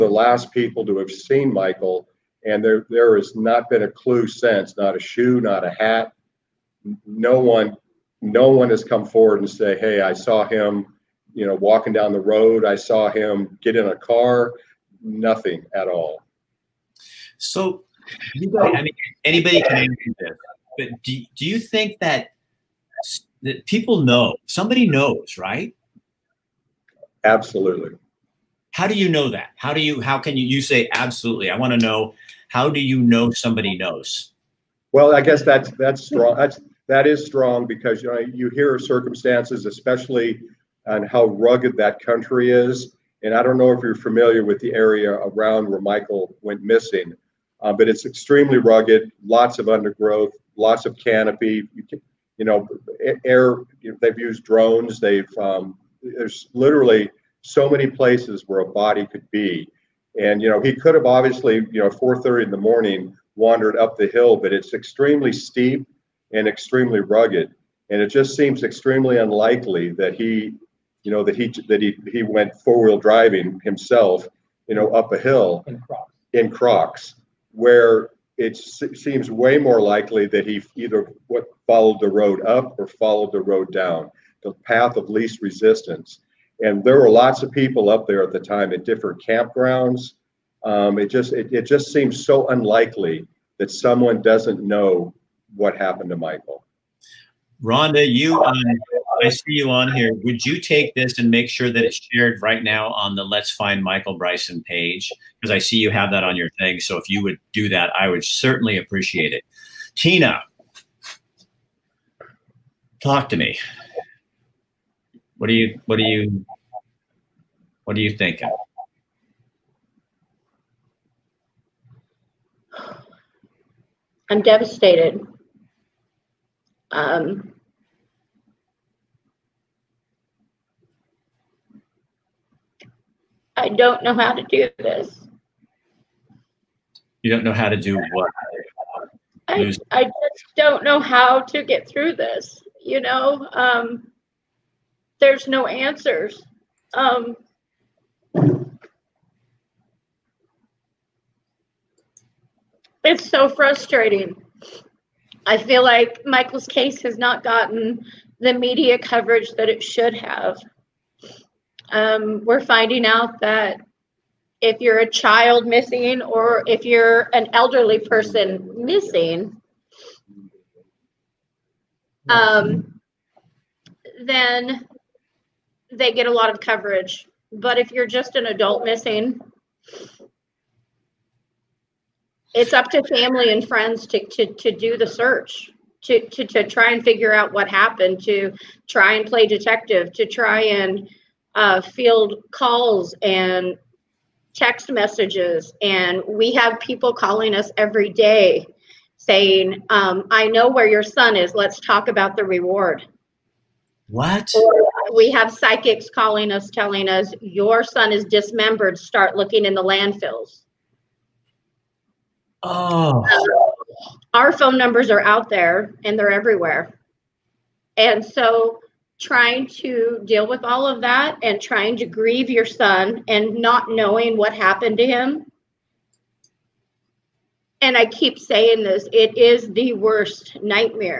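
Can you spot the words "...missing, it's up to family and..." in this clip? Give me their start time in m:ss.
2:58.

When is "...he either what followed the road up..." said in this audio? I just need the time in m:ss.
1:20.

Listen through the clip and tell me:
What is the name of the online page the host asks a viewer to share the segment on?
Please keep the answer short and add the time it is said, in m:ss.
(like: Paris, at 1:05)
Let's Find Michael Bryson, at 1:43.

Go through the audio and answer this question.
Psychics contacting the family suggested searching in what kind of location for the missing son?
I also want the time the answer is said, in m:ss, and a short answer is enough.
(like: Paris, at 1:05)
landfills, at 3:29.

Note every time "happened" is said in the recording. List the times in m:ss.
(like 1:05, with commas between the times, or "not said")
1:35, 3:07, 3:44.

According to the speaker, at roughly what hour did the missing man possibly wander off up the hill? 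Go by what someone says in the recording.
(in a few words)
4:30 in the morning.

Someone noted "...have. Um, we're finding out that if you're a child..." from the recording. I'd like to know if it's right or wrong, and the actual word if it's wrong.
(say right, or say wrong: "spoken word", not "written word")
right.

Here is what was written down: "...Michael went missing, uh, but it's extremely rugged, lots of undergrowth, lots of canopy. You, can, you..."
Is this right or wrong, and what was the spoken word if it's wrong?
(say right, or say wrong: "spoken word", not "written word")
right.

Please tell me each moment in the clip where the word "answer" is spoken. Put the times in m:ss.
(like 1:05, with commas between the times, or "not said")
0:19, 2:25.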